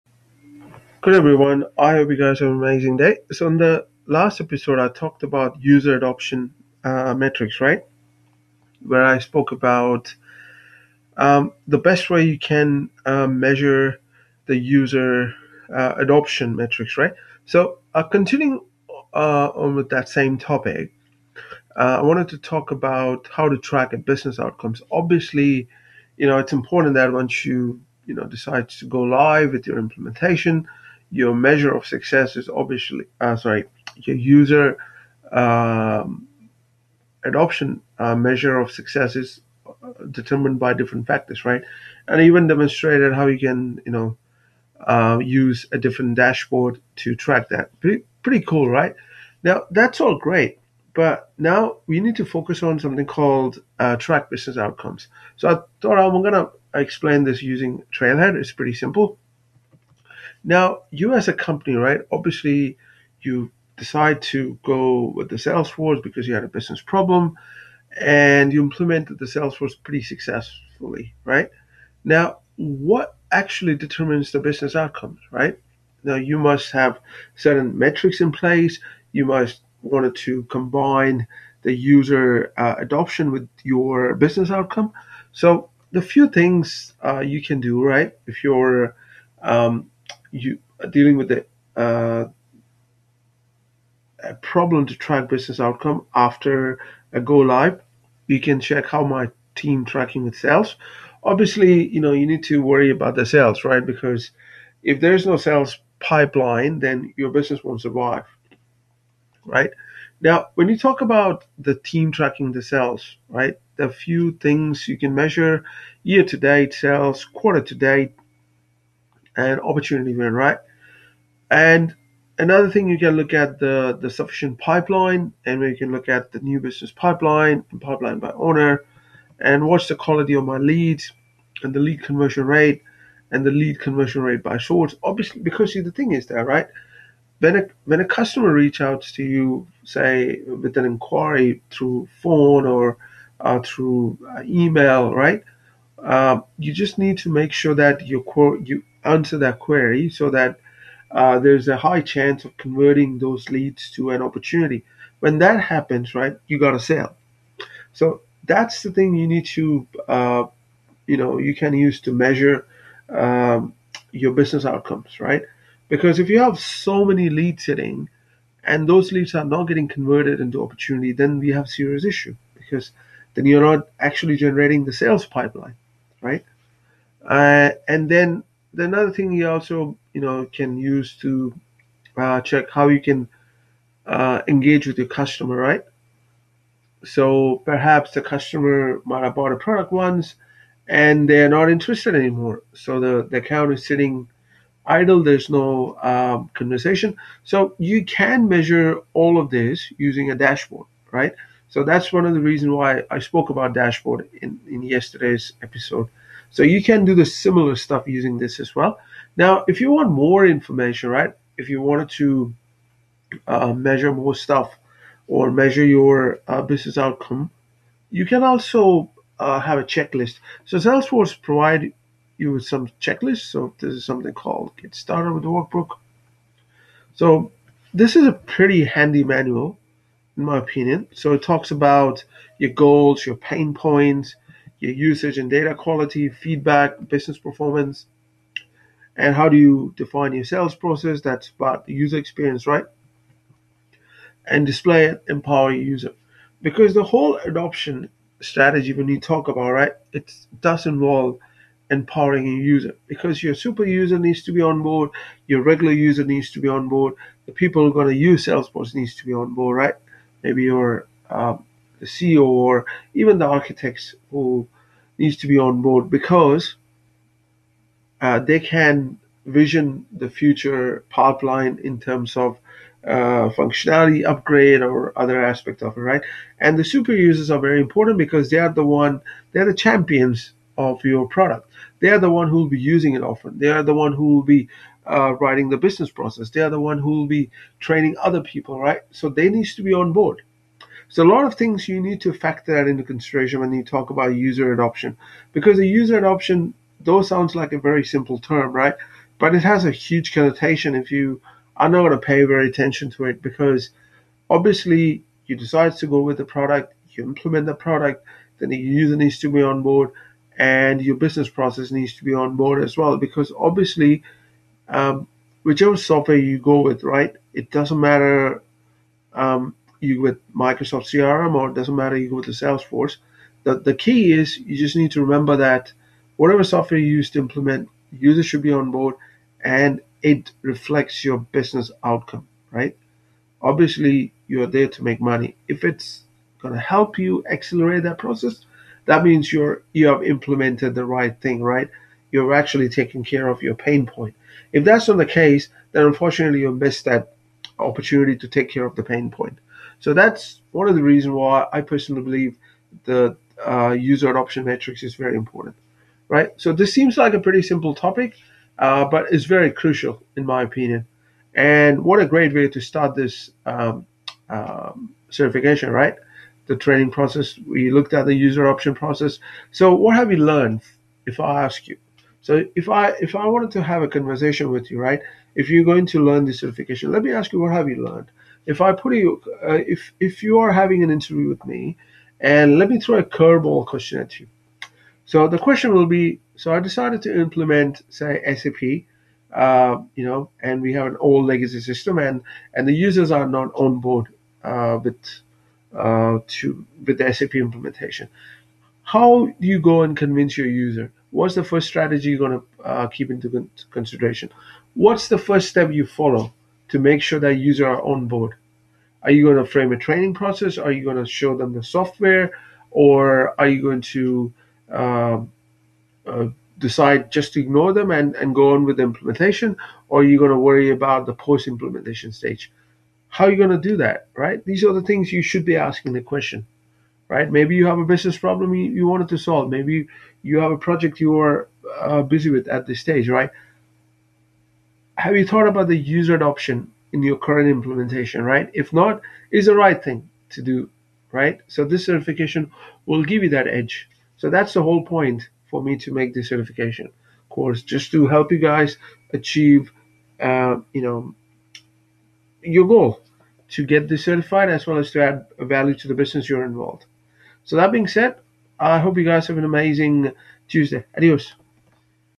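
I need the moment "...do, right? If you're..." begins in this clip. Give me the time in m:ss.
1:27.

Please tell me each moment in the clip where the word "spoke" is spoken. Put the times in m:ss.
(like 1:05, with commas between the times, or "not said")
0:09, 3:23.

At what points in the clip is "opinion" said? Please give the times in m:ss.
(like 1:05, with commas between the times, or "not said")
3:50, 6:00.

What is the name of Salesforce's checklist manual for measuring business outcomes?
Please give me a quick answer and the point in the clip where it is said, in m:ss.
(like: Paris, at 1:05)
Get Started with the Workbook, at 3:44.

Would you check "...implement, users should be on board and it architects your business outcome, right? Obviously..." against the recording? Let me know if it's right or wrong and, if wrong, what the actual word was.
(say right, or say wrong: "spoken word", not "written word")
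wrong: "reflects", not "architects".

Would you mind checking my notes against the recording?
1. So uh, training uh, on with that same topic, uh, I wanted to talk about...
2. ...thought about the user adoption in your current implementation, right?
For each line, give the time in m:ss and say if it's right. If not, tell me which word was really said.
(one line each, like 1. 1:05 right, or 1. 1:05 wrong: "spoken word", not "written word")
1. 0:17 wrong: "continuing", not "training"
2. 7:15 right.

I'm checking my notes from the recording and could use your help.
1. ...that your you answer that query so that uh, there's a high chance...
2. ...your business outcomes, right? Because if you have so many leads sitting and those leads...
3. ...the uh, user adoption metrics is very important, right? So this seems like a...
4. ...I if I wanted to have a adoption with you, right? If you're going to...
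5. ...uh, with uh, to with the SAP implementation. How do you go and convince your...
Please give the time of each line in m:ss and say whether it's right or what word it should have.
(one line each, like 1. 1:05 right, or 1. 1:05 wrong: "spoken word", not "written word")
1. 2:27 right
2. 2:44 right
3. 5:53 right
4. 6:12 wrong: "conversation", not "adoption"
5. 6:34 right.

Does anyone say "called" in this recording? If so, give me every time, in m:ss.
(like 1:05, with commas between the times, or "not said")
0:53, 3:44.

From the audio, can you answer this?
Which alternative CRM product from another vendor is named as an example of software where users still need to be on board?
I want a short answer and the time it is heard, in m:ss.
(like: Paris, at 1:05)
Microsoft CRM, at 5:20.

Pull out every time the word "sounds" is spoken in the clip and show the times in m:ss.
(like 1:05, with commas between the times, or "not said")
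4:57.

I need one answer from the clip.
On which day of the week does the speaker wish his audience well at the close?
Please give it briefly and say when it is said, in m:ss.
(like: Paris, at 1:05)
Tuesday, at 7:40.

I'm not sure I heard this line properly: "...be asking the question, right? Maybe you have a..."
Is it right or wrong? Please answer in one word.
right.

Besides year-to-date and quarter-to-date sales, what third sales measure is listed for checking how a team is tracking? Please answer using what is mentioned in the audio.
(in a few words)
Opportunity win.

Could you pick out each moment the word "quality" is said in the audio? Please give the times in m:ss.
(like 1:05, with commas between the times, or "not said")
2:09, 3:55.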